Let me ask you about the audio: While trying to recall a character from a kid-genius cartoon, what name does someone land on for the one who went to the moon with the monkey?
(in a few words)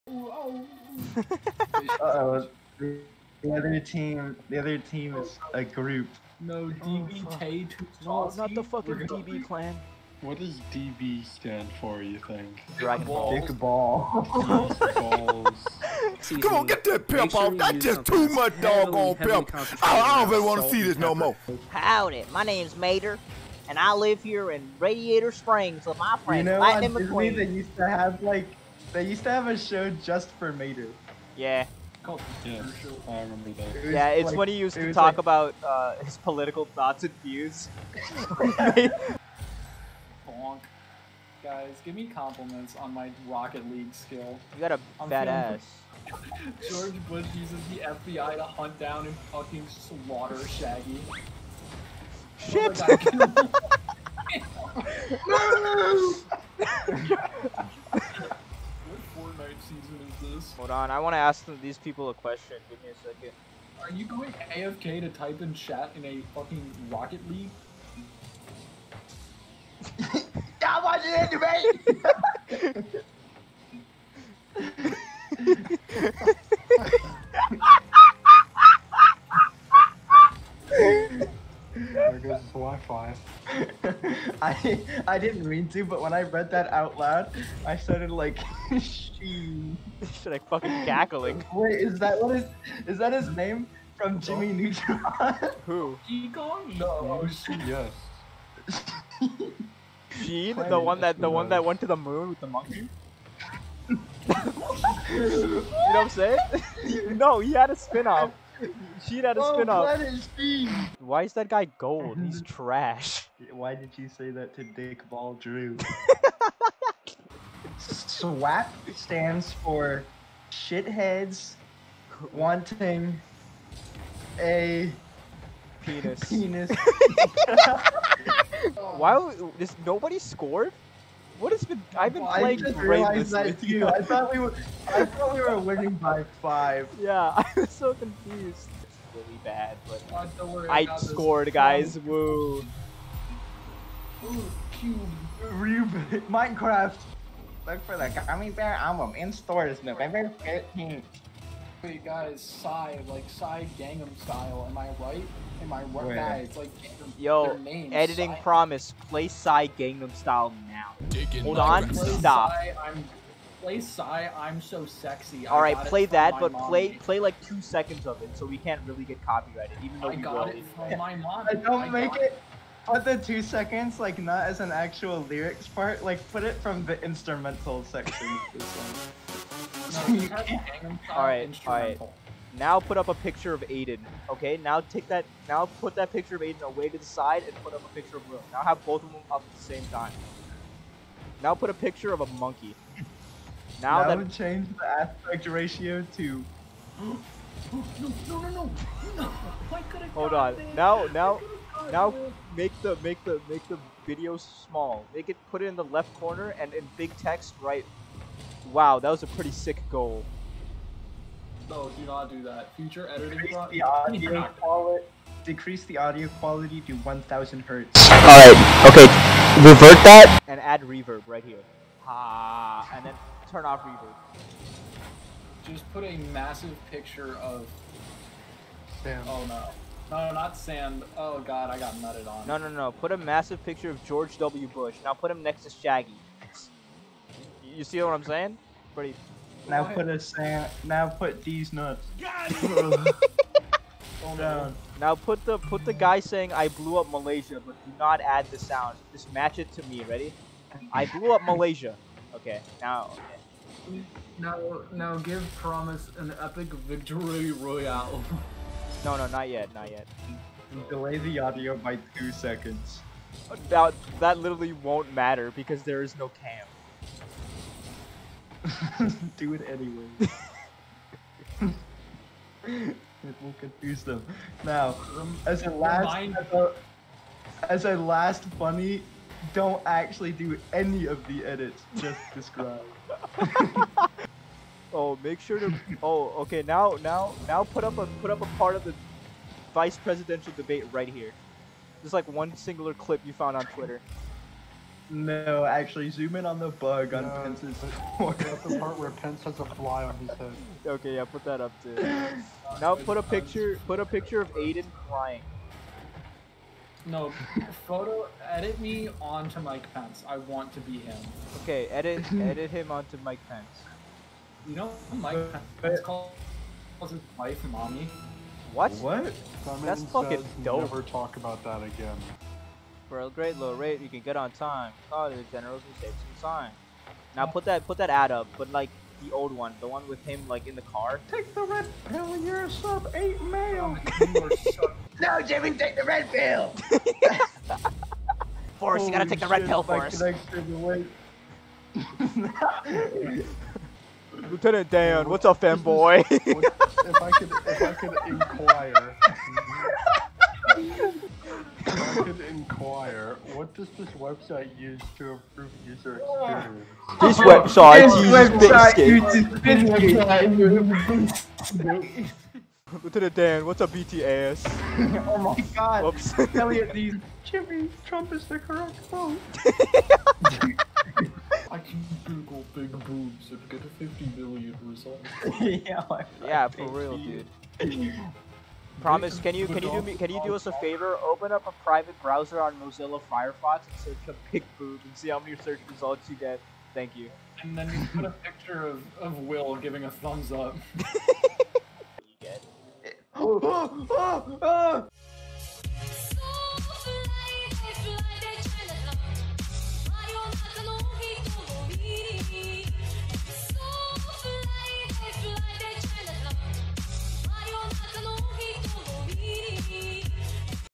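Sheen.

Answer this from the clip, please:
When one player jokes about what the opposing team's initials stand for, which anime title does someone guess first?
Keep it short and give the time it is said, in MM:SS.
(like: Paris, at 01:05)
Dragon Ball, at 00:12.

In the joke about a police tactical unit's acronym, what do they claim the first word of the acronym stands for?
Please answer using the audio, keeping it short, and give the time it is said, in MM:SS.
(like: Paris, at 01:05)
shitheads, at 02:00.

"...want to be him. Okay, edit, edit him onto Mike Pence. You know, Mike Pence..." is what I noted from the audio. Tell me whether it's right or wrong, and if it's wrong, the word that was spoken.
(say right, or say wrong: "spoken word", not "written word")
right.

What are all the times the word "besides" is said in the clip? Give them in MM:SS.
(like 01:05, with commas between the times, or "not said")
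not said.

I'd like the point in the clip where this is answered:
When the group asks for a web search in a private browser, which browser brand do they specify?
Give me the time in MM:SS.
06:22.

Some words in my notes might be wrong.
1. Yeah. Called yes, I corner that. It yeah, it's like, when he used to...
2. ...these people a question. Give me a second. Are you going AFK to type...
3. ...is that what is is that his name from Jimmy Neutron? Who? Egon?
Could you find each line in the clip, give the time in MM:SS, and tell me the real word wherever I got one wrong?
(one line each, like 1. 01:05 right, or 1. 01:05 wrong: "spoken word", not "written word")
1. 00:31 wrong: "remember", not "corner"
2. 01:01 right
3. 01:31 right.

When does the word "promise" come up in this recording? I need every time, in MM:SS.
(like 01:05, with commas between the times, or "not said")
02:38, 04:15, 06:18.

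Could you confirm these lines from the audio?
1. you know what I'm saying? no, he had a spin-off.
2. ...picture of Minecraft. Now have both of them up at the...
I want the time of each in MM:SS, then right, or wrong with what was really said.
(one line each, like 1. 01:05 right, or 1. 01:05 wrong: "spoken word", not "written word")
1. 01:43 right
2. 03:07 wrong: "Will", not "Minecraft".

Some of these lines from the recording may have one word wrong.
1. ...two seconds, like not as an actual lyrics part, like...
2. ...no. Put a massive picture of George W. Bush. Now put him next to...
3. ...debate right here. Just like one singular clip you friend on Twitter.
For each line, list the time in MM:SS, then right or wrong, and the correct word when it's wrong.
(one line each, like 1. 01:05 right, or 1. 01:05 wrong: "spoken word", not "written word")
1. 02:53 right
2. 03:52 right
3. 04:50 wrong: "found", not "friend".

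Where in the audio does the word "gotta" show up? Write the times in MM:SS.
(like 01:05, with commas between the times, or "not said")
05:39.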